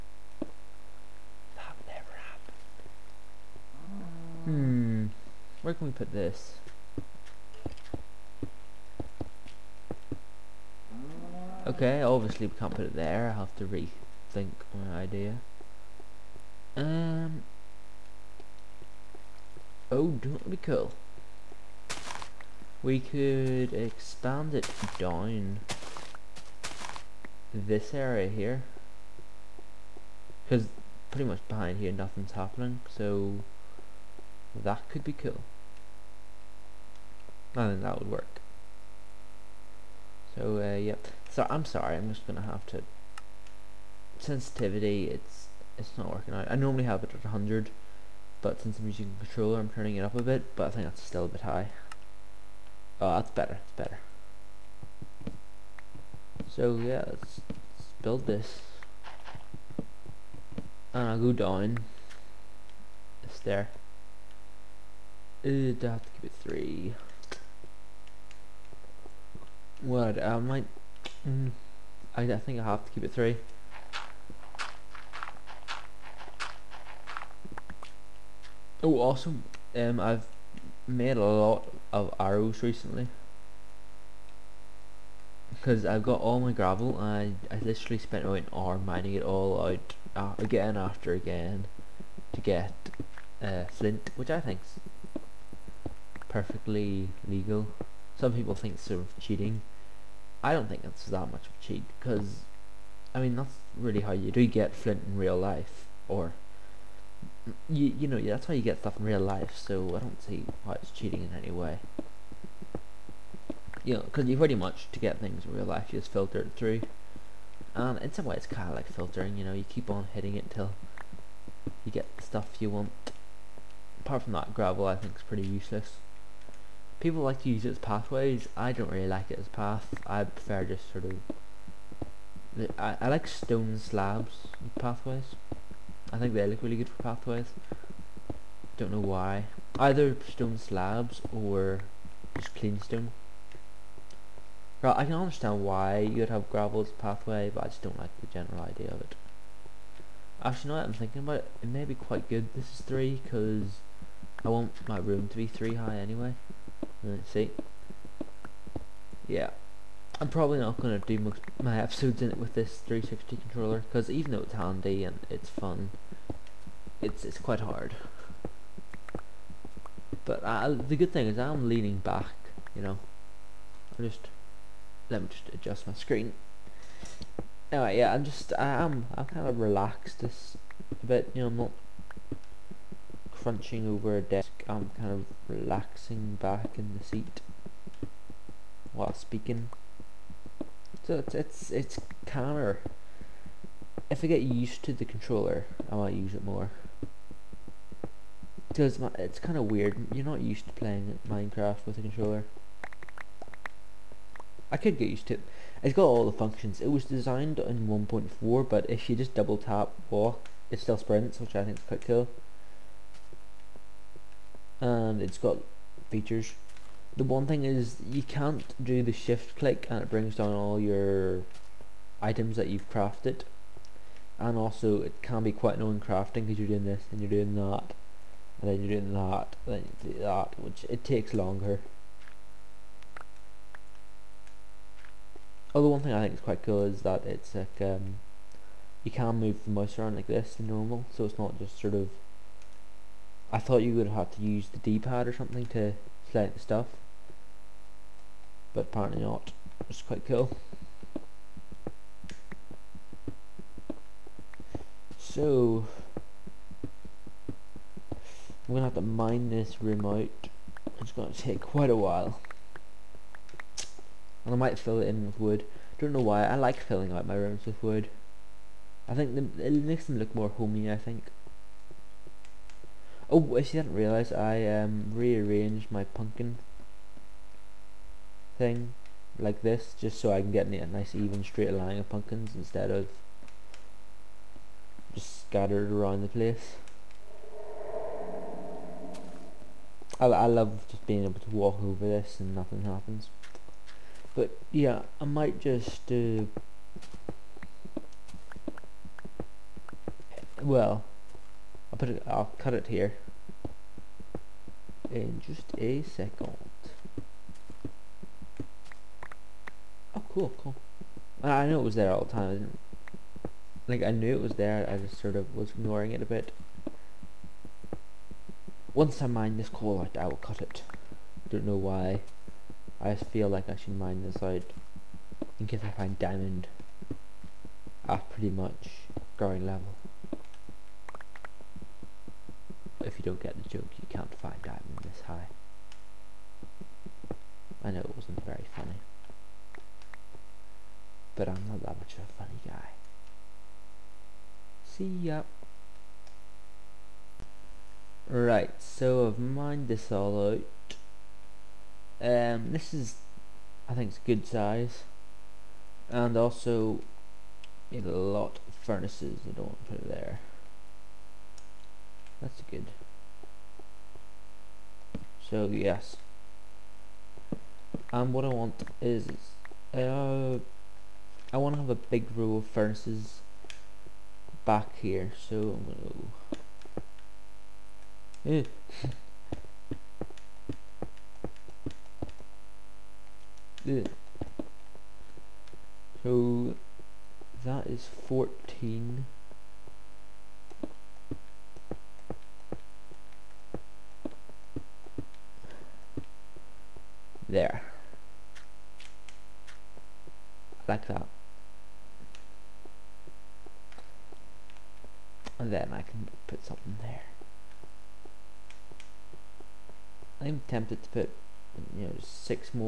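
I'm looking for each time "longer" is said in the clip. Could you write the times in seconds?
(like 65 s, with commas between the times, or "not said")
231 s.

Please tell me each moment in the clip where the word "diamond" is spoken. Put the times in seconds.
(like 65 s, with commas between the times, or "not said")
326 s, 334 s.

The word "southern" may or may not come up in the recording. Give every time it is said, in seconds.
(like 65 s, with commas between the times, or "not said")
not said.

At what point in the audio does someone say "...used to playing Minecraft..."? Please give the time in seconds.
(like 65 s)
200 s.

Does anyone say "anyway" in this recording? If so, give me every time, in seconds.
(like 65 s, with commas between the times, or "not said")
155 s, 177 s.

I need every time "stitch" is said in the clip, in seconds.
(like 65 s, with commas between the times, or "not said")
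not said.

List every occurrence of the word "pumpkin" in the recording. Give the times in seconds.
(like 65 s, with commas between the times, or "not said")
276 s, 282 s.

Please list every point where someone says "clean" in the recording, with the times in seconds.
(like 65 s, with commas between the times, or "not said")
142 s.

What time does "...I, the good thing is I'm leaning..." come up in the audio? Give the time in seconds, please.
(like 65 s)
170 s.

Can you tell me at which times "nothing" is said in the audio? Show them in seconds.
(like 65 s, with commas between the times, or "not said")
31 s, 292 s.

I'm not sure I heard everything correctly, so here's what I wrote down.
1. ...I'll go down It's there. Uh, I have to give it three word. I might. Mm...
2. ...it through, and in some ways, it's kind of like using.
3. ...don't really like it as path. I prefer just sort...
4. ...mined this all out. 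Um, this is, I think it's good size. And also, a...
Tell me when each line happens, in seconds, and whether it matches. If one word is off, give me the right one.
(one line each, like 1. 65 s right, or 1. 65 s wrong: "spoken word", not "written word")
1. 61 s right
2. 116 s wrong: "filtering", not "using"
3. 128 s right
4. 349 s right.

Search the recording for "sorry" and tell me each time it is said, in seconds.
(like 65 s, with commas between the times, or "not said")
41 s.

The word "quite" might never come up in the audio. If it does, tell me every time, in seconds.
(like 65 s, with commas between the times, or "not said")
151 s, 167 s, 211 s, 225 s, 236 s, 250 s, 261 s.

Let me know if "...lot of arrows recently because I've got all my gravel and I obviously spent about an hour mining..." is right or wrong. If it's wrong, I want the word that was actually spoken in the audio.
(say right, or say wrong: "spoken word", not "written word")
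wrong: "literally", not "obviously".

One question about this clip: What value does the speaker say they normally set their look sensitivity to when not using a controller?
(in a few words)
100.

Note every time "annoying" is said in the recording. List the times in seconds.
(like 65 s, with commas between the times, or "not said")
225 s.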